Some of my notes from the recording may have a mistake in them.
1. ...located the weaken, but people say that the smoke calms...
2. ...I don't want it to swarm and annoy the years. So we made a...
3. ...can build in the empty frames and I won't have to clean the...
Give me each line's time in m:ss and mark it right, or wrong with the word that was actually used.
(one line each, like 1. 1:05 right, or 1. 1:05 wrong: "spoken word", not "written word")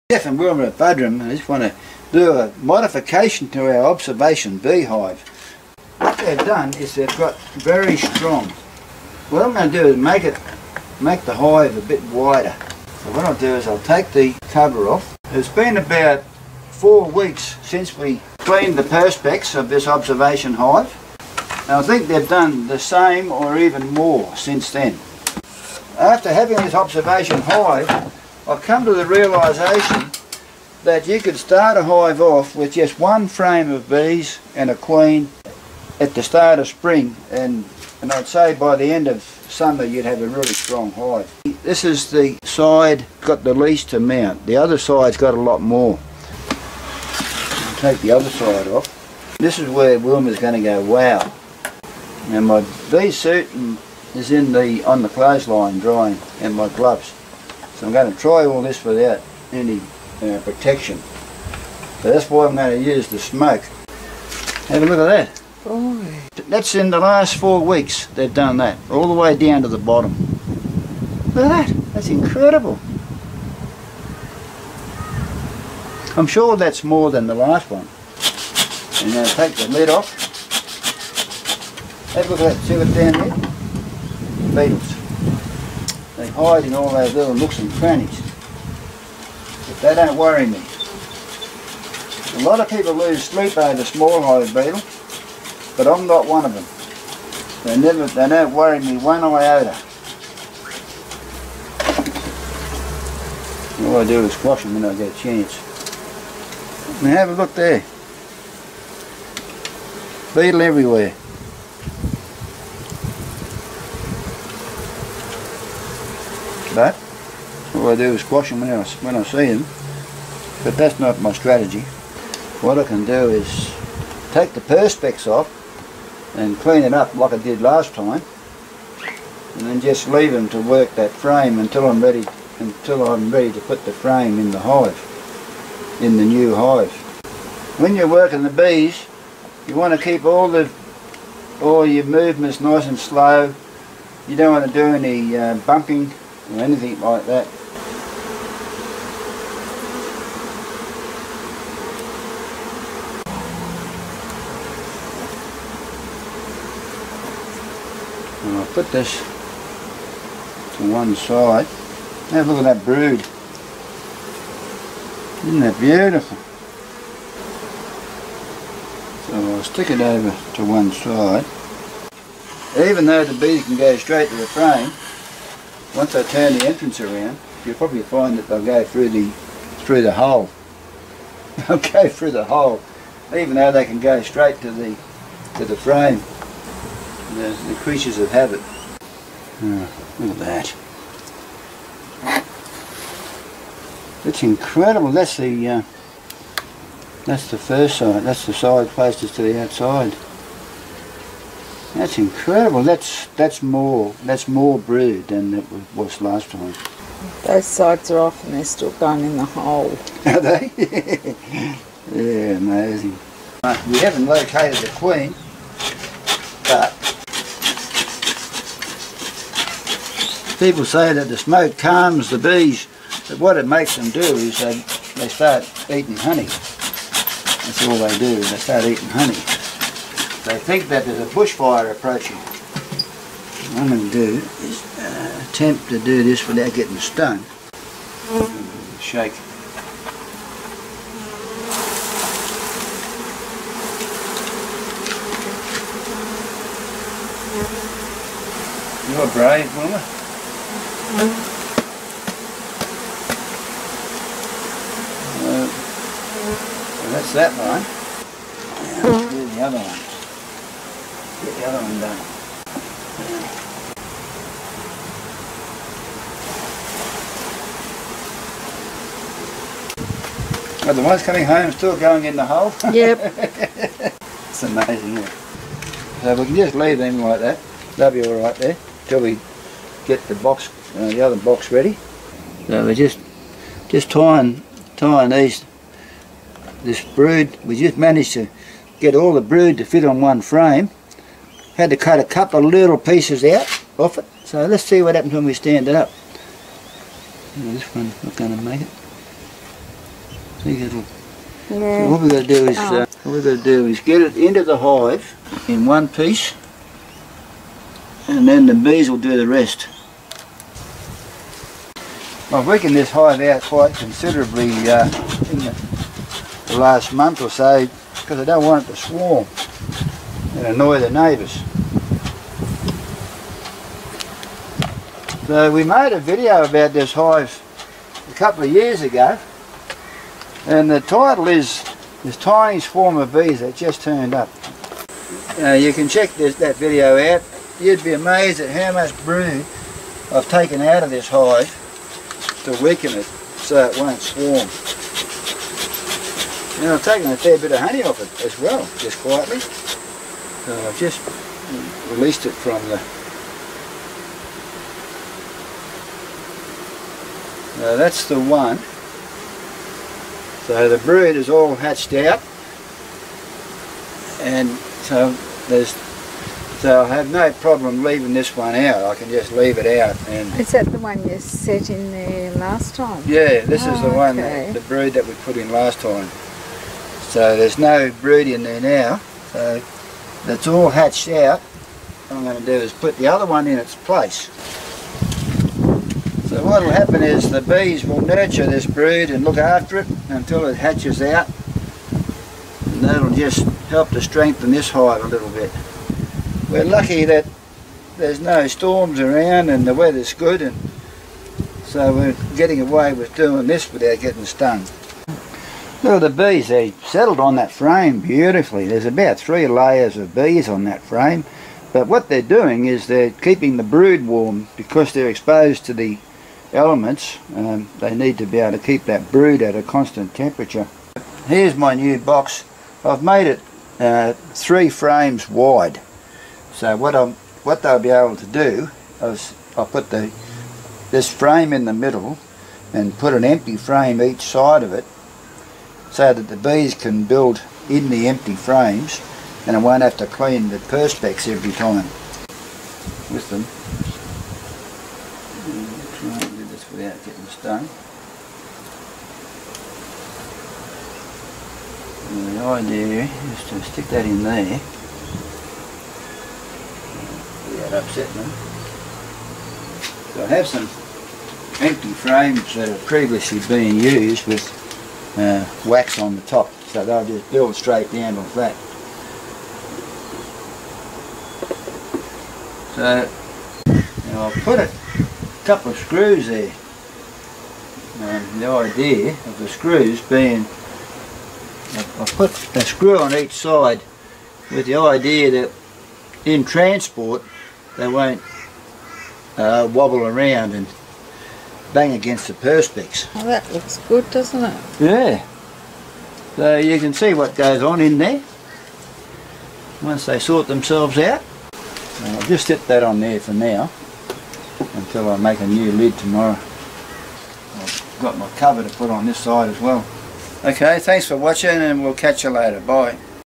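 1. 3:34 wrong: "queen", not "weaken"
2. 5:18 wrong: "neighbours", not "years"
3. 7:16 right.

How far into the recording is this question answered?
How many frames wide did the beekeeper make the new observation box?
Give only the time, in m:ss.
7:04.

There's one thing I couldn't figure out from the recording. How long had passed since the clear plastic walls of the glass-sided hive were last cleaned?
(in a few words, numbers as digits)
4 weeks.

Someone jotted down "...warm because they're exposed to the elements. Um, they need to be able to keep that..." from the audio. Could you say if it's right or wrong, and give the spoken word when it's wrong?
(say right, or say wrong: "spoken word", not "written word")
right.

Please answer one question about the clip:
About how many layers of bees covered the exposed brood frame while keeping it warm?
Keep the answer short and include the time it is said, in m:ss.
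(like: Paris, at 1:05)
3, at 6:49.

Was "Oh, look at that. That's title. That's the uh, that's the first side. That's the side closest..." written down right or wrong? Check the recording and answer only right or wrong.
wrong.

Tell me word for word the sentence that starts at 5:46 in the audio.
And I've taken a fair bit of honey off it as well, just quietly.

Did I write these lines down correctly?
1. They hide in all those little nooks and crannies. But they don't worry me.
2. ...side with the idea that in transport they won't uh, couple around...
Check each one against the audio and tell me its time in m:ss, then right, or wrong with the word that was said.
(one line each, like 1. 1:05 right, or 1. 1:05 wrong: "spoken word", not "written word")
1. 1:26 right
2. 8:03 wrong: "wobble", not "couple".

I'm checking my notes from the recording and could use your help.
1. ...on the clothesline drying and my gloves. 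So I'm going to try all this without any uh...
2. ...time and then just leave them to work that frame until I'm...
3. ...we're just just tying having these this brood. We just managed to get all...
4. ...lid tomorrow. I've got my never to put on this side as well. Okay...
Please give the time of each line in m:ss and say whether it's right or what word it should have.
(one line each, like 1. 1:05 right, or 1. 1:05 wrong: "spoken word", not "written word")
1. 0:54 right
2. 2:07 right
3. 4:42 wrong: "tying", not "having"
4. 8:25 wrong: "cover", not "never".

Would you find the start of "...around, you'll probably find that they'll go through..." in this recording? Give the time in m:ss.
2:57.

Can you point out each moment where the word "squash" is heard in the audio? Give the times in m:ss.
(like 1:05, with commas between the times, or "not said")
1:44, 1:58.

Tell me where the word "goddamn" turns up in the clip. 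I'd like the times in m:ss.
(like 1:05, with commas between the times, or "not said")
not said.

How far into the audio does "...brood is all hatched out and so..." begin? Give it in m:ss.
6:00.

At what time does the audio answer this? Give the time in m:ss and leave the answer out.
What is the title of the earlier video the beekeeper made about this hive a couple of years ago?
5:32.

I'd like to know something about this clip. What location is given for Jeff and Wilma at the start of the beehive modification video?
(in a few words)
Buderim.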